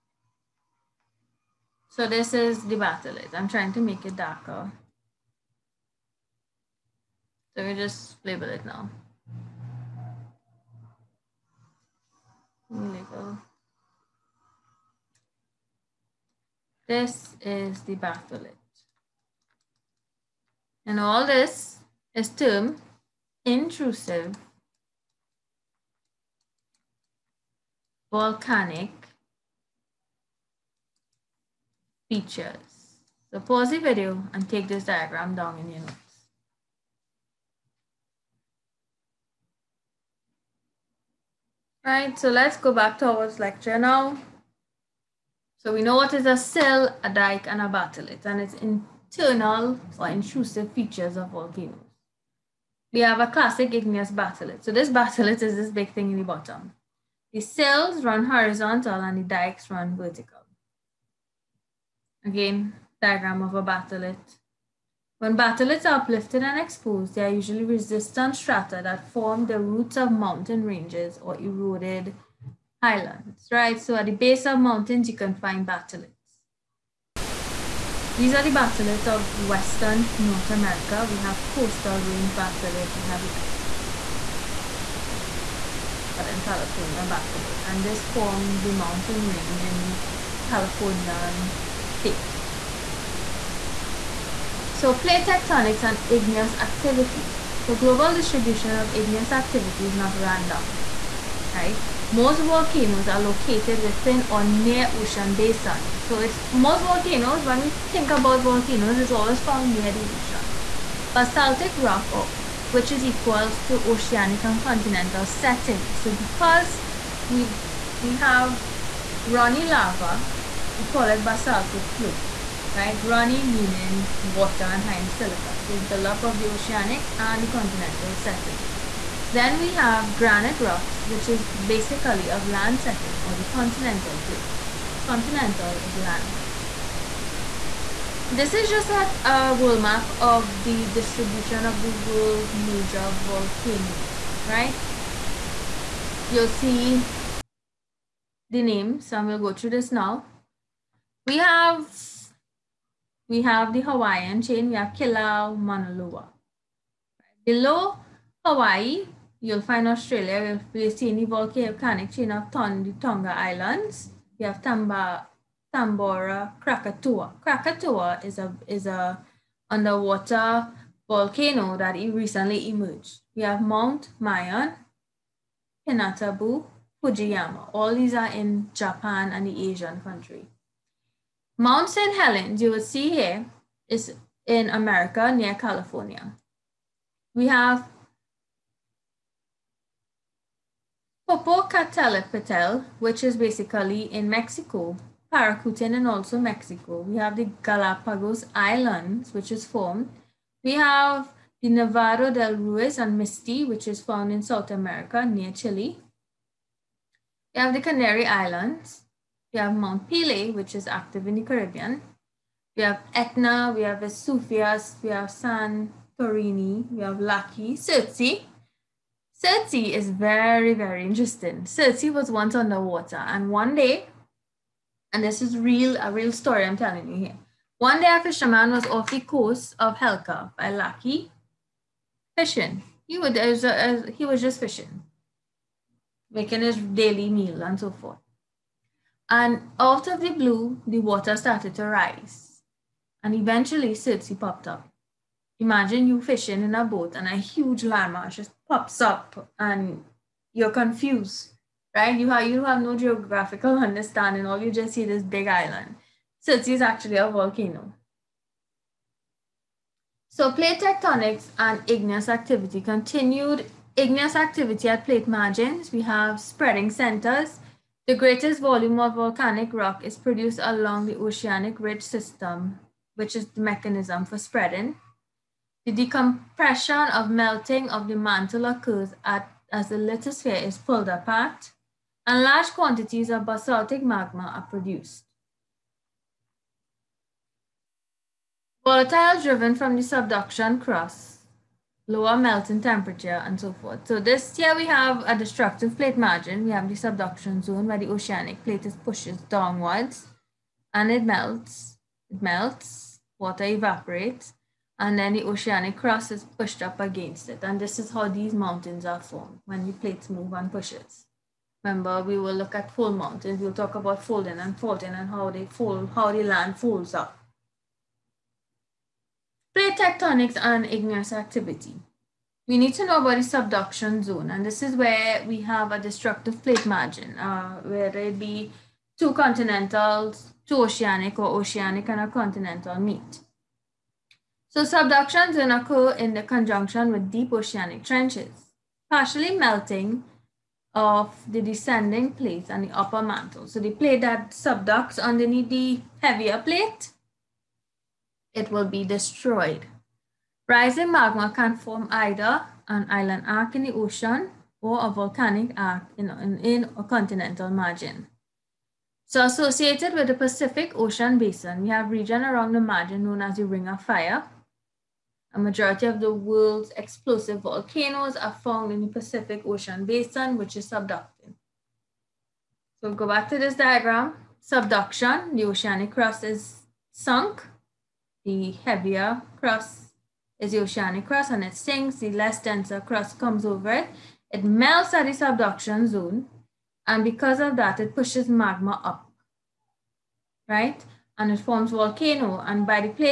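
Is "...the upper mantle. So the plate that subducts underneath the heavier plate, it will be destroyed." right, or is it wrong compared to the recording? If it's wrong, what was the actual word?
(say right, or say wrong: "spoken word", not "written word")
right.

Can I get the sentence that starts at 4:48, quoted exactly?
Volatile driven from the subduction crust, lower melting temperature and so forth.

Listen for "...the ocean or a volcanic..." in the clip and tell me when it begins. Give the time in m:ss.
5:53.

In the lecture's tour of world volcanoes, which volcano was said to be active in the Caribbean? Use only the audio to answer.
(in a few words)
Mount Pelee.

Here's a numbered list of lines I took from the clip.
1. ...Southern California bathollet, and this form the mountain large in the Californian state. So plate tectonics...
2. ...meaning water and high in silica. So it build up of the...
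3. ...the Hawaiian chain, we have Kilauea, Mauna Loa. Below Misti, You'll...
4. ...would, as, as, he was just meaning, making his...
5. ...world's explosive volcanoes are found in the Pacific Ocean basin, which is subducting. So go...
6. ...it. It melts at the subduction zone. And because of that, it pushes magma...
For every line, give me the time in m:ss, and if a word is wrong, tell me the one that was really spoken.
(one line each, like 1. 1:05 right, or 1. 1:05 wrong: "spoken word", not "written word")
1. 1:26 wrong: "range", not "large"
2. 2:03 right
3. 2:33 wrong: "Hawaii", not "Misti"
4. 3:53 wrong: "fishing", not "meaning"
5. 6:06 right
6. 6:23 right.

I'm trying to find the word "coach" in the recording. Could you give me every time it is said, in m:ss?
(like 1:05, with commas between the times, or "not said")
not said.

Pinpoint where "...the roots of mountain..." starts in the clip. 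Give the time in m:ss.
1:09.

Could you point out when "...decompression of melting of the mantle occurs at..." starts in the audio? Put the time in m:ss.
4:35.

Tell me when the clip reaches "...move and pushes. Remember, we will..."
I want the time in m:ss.
5:10.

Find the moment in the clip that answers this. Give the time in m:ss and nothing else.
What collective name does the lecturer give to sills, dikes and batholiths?
0:23.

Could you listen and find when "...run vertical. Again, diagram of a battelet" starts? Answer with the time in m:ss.
0:59.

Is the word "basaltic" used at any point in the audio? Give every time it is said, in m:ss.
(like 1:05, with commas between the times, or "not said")
1:51, 2:01, 4:43.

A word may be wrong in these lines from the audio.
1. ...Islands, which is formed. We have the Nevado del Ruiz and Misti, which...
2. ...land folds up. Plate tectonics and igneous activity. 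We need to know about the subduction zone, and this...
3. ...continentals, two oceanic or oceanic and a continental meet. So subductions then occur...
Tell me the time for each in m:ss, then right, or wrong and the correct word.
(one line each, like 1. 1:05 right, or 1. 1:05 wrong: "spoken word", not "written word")
1. 3:18 right
2. 5:16 right
3. 5:29 right.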